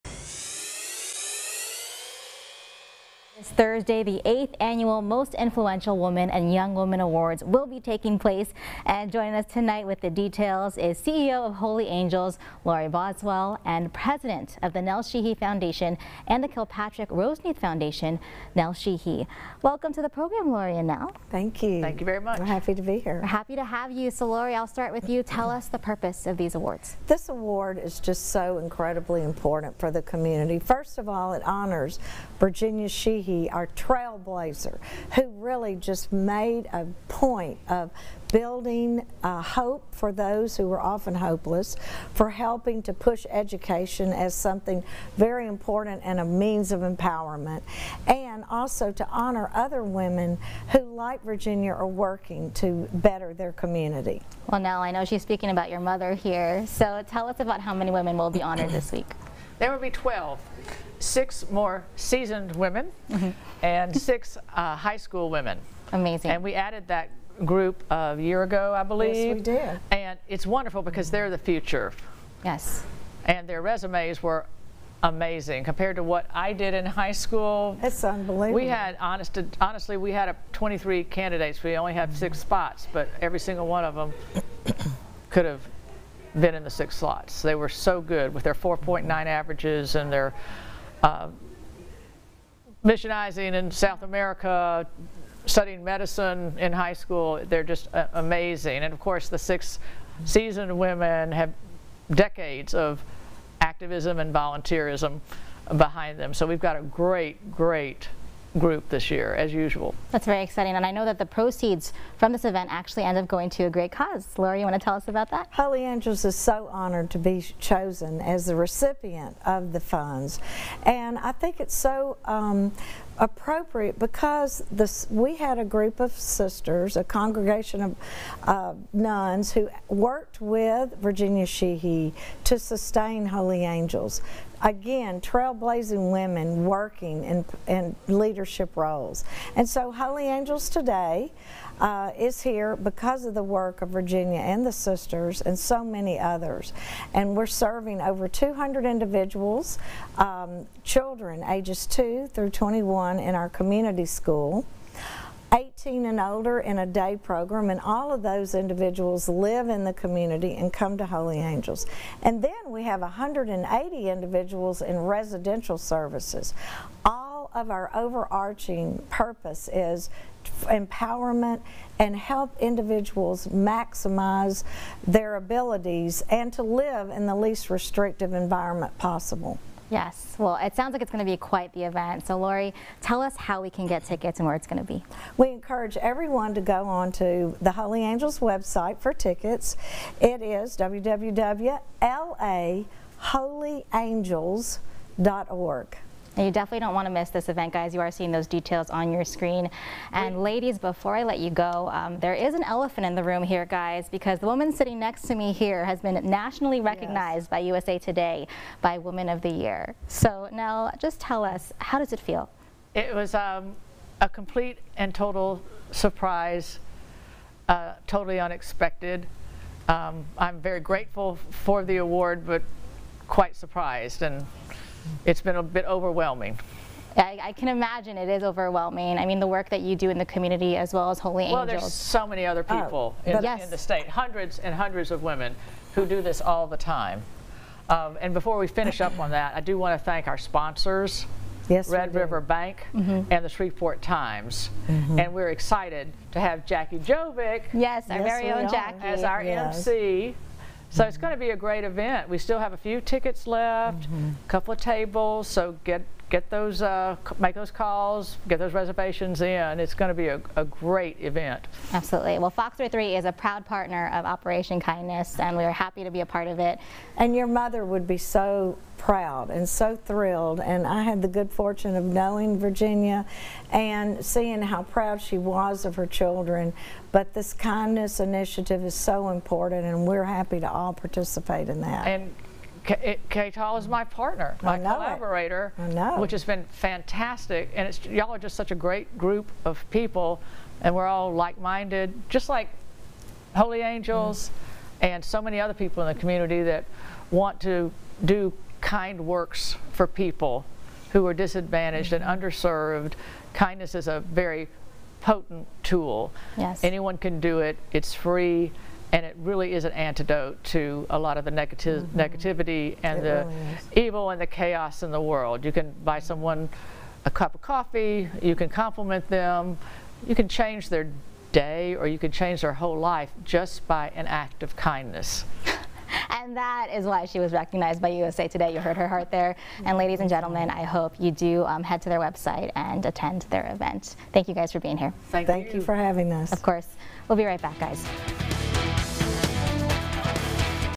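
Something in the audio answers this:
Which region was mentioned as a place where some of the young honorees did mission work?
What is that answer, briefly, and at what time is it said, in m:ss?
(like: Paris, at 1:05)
South America, at 1:33.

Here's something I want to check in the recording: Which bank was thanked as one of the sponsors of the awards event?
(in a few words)
Red River Bank.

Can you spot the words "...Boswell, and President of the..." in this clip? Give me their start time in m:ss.
0:12.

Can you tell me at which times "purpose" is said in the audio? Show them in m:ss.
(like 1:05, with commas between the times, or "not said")
0:25, 2:49.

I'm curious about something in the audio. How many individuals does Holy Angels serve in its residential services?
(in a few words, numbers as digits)
180.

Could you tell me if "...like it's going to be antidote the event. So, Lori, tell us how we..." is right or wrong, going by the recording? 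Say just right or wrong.
wrong.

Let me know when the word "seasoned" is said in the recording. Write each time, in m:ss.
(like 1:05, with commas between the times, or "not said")
1:01, 1:40.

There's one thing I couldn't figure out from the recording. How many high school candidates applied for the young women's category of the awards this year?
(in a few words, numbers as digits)
23.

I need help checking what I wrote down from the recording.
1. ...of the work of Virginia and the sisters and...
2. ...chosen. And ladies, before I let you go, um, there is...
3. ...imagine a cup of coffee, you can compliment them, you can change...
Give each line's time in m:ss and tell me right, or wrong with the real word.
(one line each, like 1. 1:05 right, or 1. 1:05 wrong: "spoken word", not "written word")
1. 2:23 right
2. 3:19 wrong: "screen", not "chosen"
3. 5:16 wrong: "someone", not "imagine".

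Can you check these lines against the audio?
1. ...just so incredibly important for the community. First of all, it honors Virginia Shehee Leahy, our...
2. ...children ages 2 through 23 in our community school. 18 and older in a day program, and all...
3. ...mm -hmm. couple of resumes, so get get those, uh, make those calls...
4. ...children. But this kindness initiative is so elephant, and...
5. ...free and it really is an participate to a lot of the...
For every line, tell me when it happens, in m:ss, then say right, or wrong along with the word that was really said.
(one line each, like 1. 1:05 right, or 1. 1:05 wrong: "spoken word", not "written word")
1. 0:27 right
2. 2:30 wrong: "21", not "23"
3. 4:14 wrong: "tables", not "resumes"
4. 4:36 wrong: "important", not "elephant"
5. 5:08 wrong: "antidote", not "participate".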